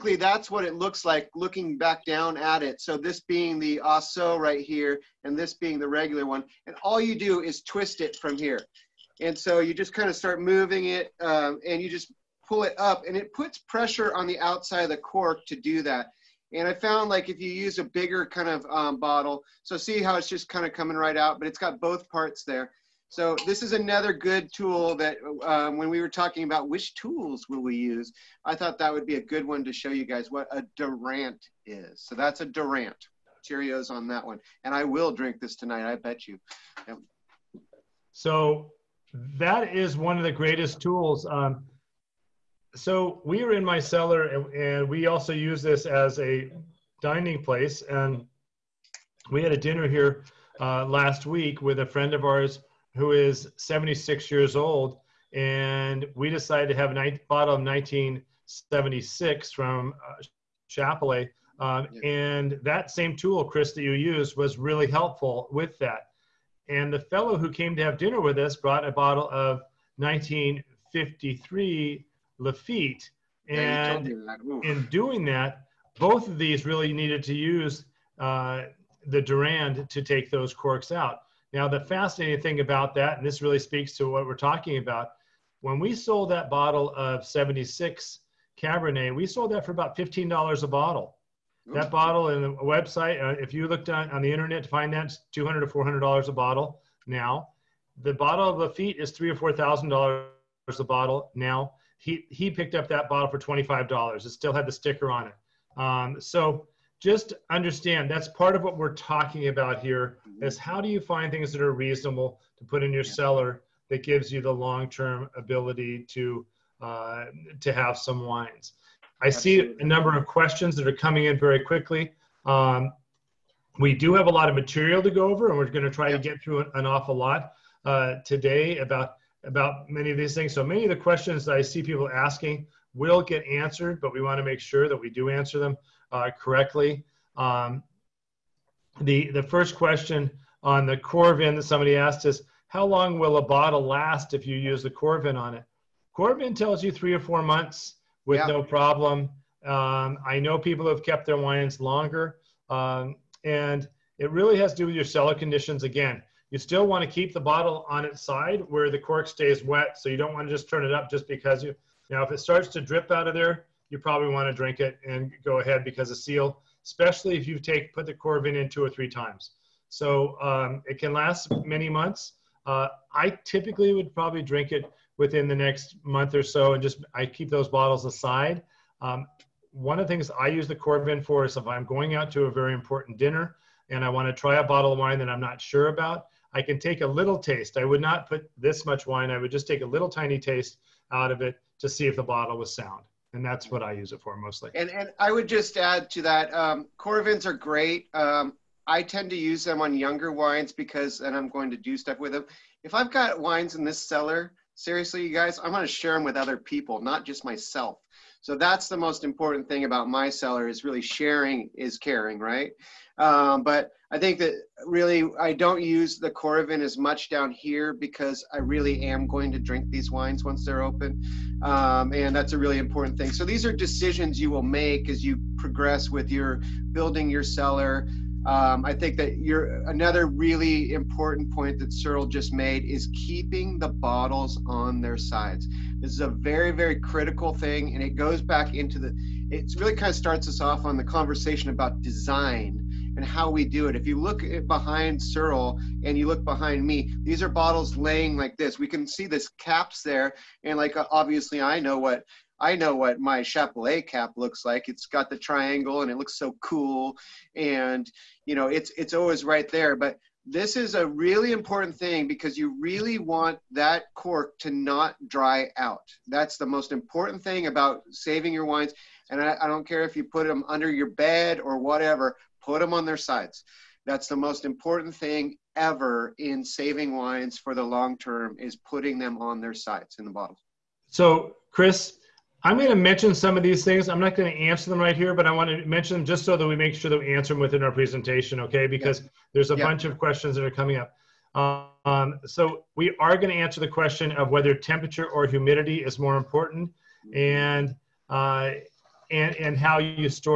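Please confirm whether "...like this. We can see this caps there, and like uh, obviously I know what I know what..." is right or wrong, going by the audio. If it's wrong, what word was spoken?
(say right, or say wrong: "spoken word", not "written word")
right.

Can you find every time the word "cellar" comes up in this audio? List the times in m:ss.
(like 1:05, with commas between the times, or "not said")
0:43, 1:53, 2:35, 3:24, 3:30, 3:47.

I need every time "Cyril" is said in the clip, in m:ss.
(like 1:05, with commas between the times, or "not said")
3:51, 4:05.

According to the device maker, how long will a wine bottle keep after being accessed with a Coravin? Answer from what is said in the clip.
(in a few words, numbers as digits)
3 or 4 months.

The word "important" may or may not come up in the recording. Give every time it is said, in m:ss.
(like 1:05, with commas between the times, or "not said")
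3:02, 3:29, 3:42, 3:50, 4:21, 4:26, 4:34, 4:56.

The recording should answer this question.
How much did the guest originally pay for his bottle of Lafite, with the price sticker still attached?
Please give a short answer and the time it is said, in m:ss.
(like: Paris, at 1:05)
$25, at 1:43.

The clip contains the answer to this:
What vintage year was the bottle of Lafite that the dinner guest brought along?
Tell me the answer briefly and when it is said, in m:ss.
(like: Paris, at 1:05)
1953, at 1:09.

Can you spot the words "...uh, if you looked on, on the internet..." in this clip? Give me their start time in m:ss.
1:33.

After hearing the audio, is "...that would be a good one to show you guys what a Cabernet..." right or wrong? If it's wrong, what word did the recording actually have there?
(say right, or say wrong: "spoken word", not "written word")
wrong: "Durand", not "Cabernet".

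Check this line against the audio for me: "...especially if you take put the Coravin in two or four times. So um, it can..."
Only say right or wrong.
wrong.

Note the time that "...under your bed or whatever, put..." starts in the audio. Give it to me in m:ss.
4:30.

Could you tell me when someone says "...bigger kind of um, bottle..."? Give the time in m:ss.
0:17.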